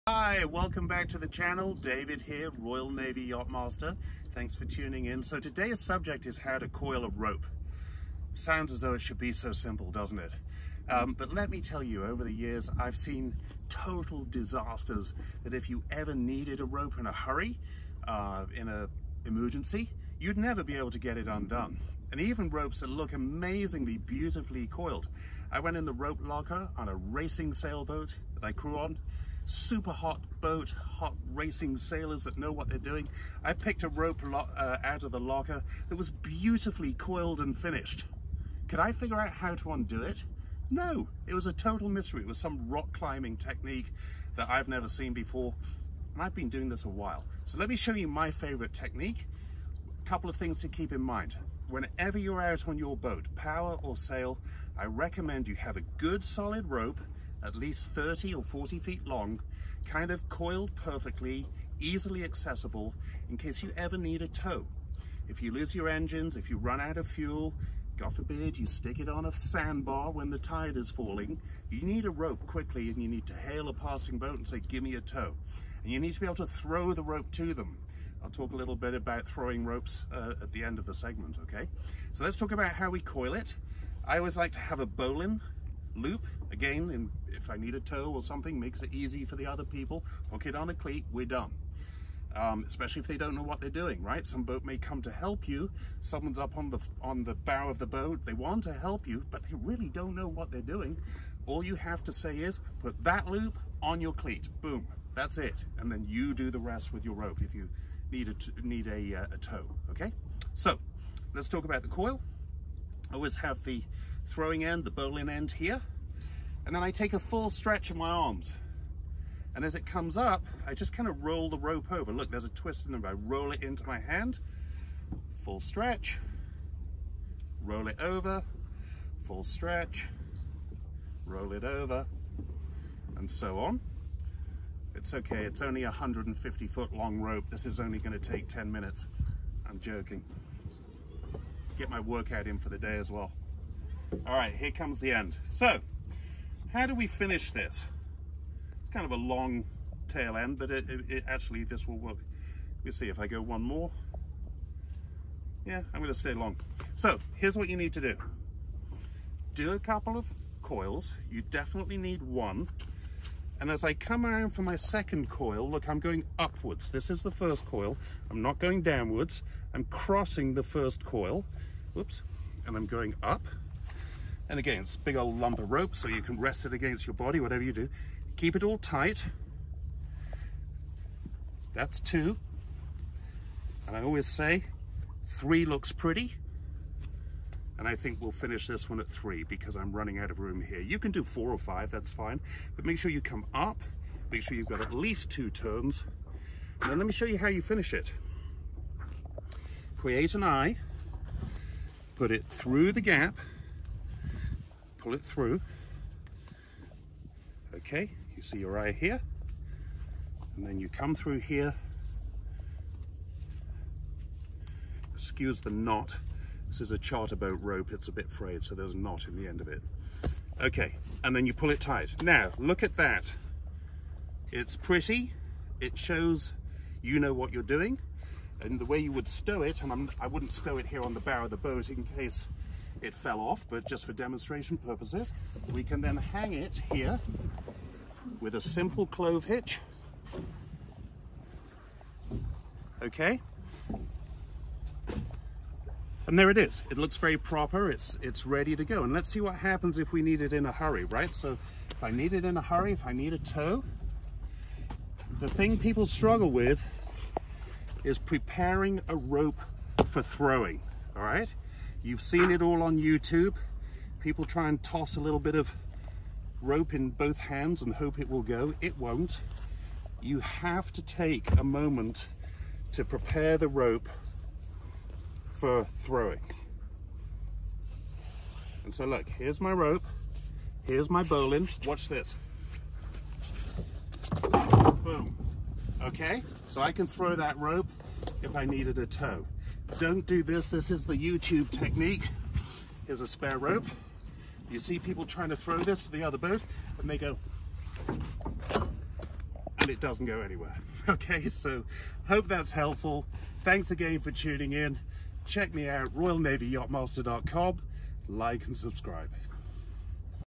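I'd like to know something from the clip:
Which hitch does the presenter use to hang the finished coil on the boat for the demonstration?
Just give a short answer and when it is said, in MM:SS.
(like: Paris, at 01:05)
clove hitch, at 03:59.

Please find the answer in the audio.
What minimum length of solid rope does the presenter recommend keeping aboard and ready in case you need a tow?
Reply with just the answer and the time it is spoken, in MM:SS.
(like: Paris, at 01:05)
30 or 40 feet, at 00:57.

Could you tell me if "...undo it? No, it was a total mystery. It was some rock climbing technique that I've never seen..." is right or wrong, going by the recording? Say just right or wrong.
right.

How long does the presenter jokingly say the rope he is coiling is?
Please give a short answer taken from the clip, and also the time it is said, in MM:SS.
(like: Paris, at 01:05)
150 feet, at 02:15.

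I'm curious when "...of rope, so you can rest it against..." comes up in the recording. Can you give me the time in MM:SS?
02:55.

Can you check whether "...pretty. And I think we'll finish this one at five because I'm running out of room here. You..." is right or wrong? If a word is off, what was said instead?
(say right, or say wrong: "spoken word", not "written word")
wrong: "three", not "five".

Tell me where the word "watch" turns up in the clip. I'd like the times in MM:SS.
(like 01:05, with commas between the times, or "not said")
04:41.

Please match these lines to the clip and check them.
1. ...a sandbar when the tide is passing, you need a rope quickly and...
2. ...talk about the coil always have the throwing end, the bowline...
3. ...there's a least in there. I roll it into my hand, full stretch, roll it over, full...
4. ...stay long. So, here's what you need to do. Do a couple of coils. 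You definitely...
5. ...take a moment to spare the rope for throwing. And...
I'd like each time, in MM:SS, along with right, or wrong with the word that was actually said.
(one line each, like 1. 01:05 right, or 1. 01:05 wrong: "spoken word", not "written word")
1. 01:09 wrong: "falling", not "passing"
2. 01:51 right
3. 02:02 wrong: "twist", not "least"
4. 02:36 right
5. 04:31 wrong: "prepare", not "spare".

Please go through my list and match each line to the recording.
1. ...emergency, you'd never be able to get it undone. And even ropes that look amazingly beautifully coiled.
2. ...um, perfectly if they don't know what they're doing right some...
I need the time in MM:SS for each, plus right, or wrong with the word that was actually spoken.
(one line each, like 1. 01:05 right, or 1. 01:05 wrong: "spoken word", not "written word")
1. 00:19 right
2. 01:32 wrong: "especially", not "perfectly".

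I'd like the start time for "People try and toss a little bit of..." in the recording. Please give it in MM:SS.
04:24.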